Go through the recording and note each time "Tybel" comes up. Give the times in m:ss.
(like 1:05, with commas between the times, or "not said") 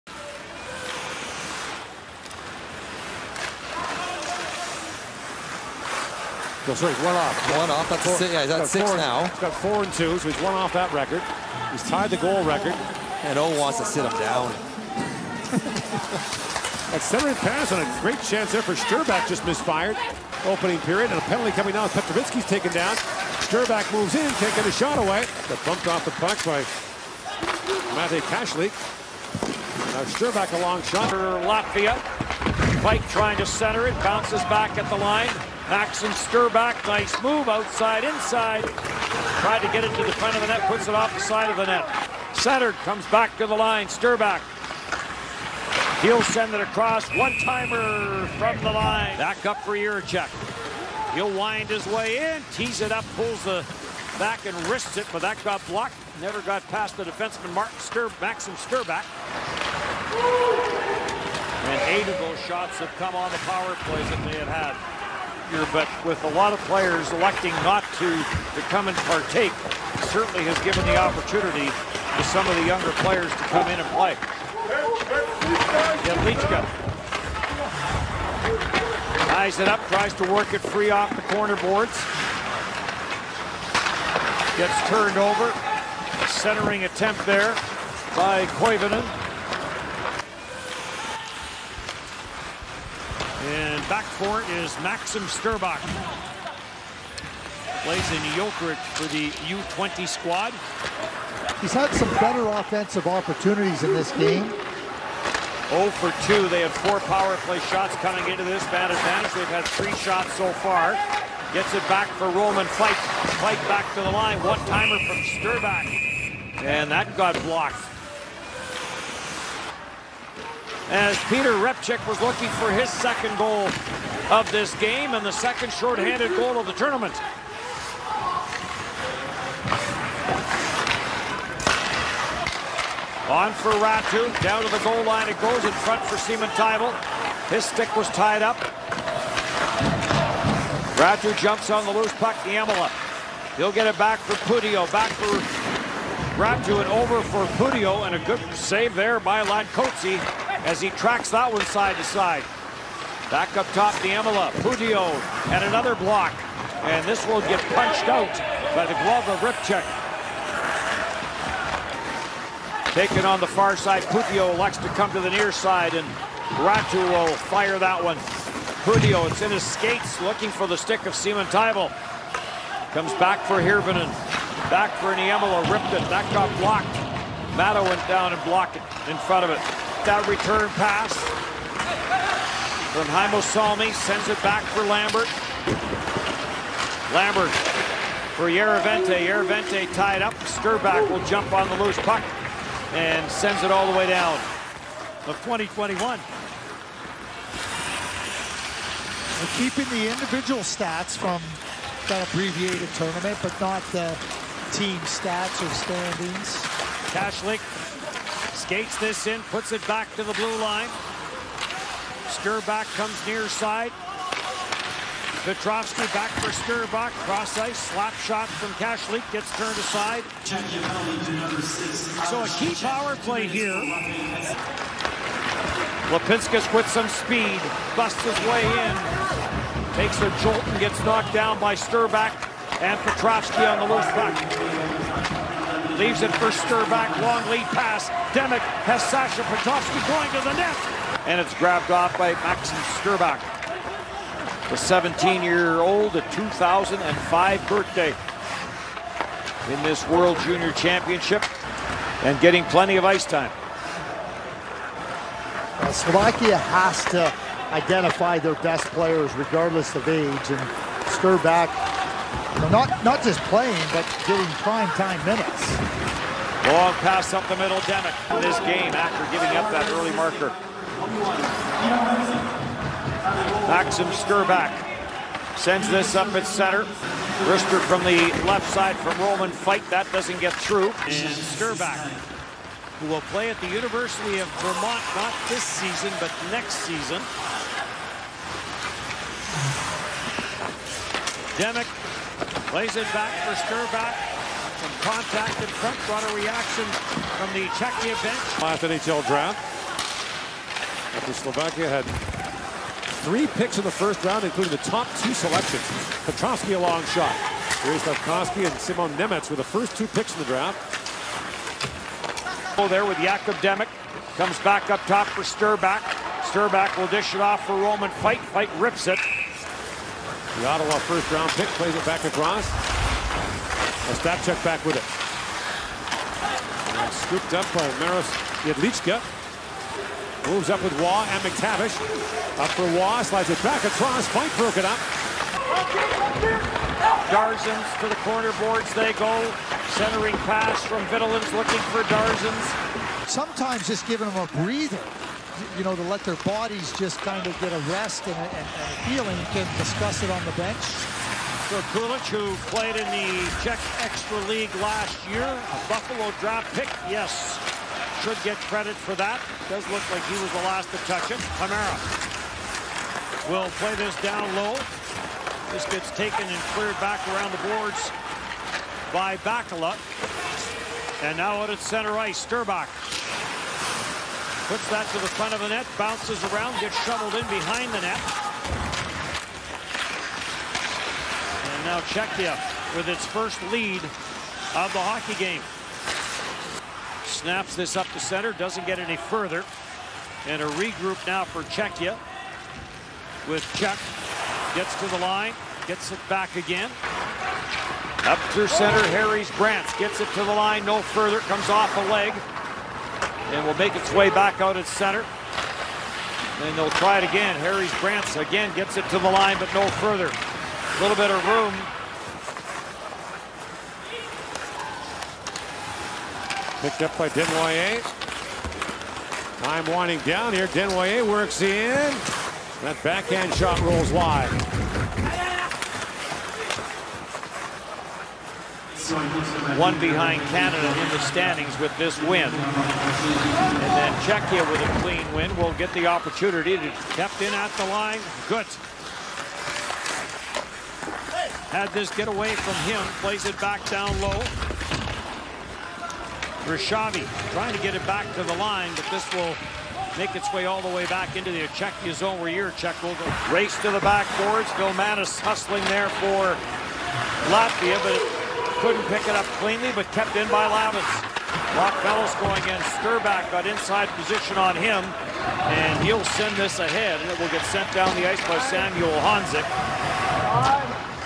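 2:16, 2:51.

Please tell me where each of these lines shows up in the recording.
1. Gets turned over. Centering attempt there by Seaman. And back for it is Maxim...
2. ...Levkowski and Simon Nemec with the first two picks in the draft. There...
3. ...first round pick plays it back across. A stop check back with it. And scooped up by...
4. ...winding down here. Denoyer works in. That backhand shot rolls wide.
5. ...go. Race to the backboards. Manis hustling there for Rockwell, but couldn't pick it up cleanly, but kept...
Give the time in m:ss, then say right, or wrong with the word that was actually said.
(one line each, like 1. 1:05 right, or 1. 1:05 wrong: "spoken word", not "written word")
1. 1:24 wrong: "Koivunen", not "Seaman"
2. 5:08 right
3. 5:21 right
4. 6:59 right
5. 7:33 wrong: "Latvia", not "Rockwell".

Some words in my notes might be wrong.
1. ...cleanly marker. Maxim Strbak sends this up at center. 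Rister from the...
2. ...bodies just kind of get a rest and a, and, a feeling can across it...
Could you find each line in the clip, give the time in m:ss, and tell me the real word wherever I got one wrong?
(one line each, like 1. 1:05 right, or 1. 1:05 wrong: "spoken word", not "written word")
1. 4:29 wrong: "early", not "cleanly"
2. 5:46 wrong: "discuss", not "across".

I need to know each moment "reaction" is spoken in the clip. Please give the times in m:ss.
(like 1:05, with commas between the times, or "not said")
4:56.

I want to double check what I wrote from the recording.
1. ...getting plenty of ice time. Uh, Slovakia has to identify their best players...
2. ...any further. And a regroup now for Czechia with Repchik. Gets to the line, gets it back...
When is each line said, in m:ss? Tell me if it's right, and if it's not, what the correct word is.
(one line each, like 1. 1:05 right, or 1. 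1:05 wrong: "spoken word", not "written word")
1. 4:12 right
2. 6:28 wrong: "Czech", not "Repchik".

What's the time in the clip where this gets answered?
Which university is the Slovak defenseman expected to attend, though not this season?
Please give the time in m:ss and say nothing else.
4:43.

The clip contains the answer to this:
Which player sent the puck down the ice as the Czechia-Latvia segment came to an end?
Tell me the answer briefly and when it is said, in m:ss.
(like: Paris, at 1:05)
Samuel Honzik, at 7:48.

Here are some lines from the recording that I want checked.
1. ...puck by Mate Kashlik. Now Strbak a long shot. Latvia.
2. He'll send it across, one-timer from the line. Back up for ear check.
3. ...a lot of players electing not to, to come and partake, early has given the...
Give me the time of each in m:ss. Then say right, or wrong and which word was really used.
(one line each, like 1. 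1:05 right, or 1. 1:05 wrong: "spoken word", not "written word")
1. 0:26 right
2. 0:46 right
3. 1:06 wrong: "certainly", not "early".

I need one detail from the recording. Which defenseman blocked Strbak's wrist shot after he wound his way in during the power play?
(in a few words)
Martin Stur.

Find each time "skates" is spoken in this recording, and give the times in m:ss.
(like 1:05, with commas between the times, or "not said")
2:49, 3:28.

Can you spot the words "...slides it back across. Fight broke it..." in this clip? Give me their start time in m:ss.
5:33.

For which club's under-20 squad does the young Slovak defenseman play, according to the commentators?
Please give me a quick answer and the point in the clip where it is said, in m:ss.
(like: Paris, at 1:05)
Jokerit, at 1:38.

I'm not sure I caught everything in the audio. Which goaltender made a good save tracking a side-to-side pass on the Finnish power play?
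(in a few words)
Ladkotzi.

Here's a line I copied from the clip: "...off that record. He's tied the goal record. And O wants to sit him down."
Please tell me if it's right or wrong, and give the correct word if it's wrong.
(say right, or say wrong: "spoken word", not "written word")
right.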